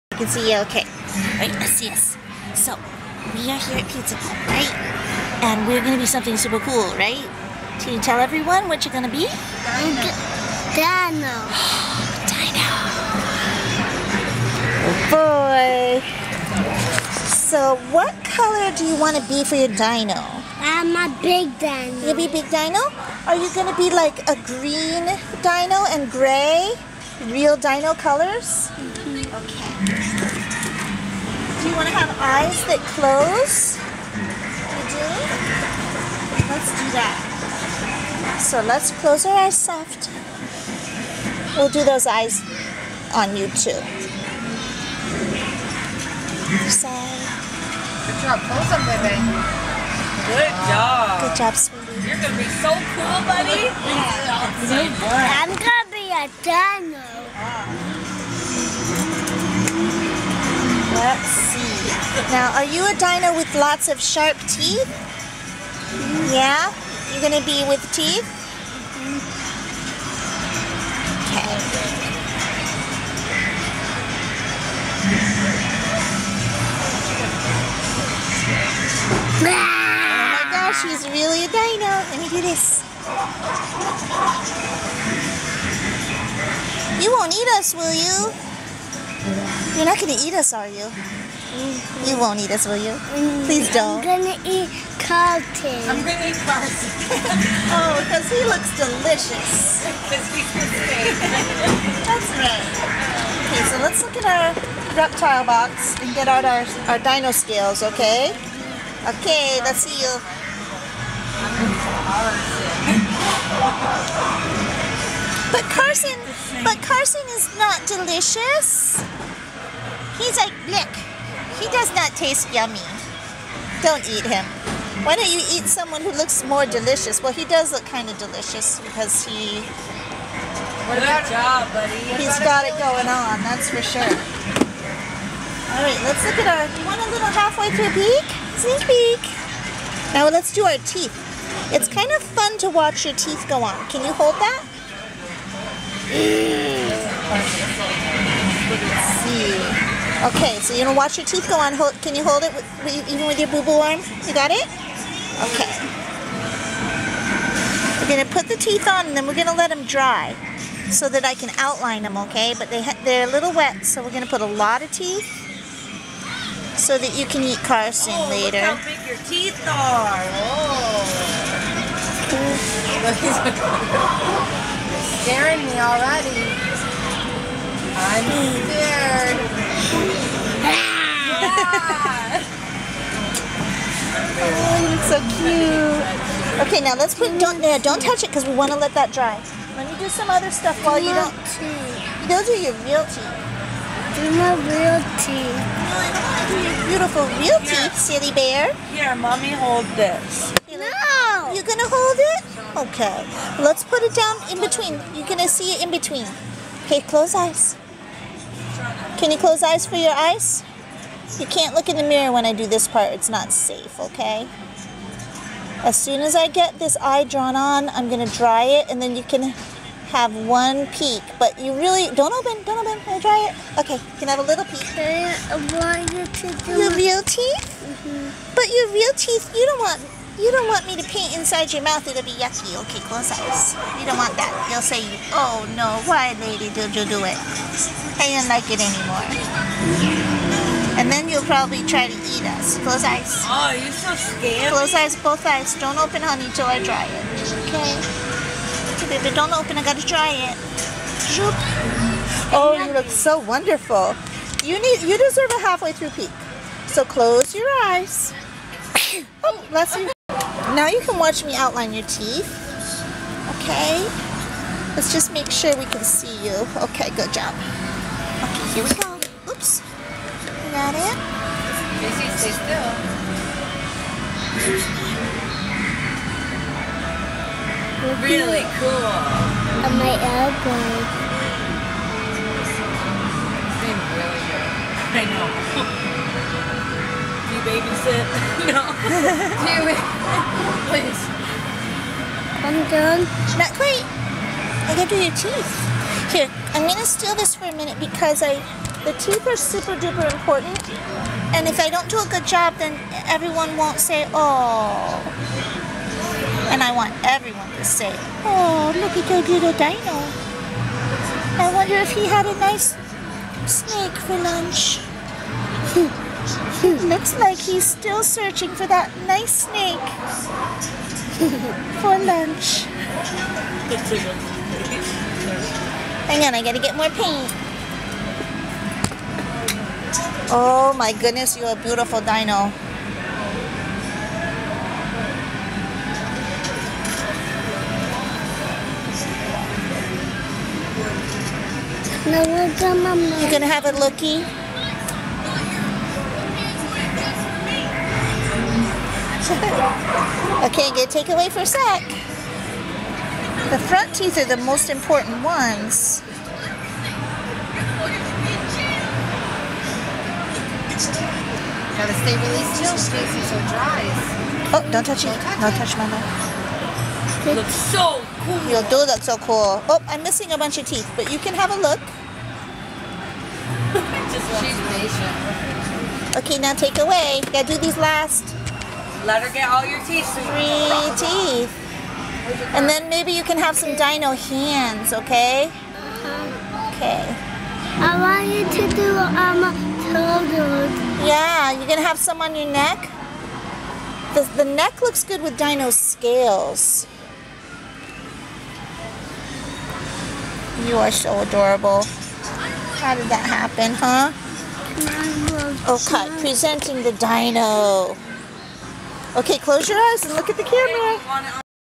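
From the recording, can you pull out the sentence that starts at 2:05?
Why don't you eat someone who looks more delicious?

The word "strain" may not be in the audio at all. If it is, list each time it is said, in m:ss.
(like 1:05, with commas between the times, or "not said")
not said.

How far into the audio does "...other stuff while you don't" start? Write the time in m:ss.
3:10.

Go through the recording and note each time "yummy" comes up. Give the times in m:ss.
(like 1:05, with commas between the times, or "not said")
2:02.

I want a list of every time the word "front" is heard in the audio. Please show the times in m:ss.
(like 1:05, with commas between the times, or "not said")
5:53.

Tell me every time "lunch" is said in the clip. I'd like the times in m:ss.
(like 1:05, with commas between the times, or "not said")
5:14, 5:22.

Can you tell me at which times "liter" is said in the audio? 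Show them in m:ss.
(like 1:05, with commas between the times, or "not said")
not said.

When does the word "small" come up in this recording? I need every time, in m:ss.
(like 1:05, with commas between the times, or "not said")
not said.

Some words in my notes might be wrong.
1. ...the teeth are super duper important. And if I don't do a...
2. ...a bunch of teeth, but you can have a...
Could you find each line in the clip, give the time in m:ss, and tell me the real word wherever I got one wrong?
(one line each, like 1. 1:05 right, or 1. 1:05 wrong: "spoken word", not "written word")
1. 4:59 right
2. 6:10 right.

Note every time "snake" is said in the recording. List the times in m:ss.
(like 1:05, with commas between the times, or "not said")
5:13, 5:19.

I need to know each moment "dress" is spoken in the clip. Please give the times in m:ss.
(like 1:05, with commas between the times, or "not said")
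not said.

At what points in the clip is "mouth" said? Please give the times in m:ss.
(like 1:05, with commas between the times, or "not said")
3:51, 6:06.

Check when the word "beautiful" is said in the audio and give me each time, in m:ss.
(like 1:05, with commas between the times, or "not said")
3:16, 5:31.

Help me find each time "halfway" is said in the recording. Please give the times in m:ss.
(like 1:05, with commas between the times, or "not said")
2:17, 4:15.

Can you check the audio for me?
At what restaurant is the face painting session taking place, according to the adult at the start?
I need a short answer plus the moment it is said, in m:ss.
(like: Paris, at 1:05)
Pizza Hut, at 0:03.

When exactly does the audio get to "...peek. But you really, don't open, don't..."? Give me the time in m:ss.
3:40.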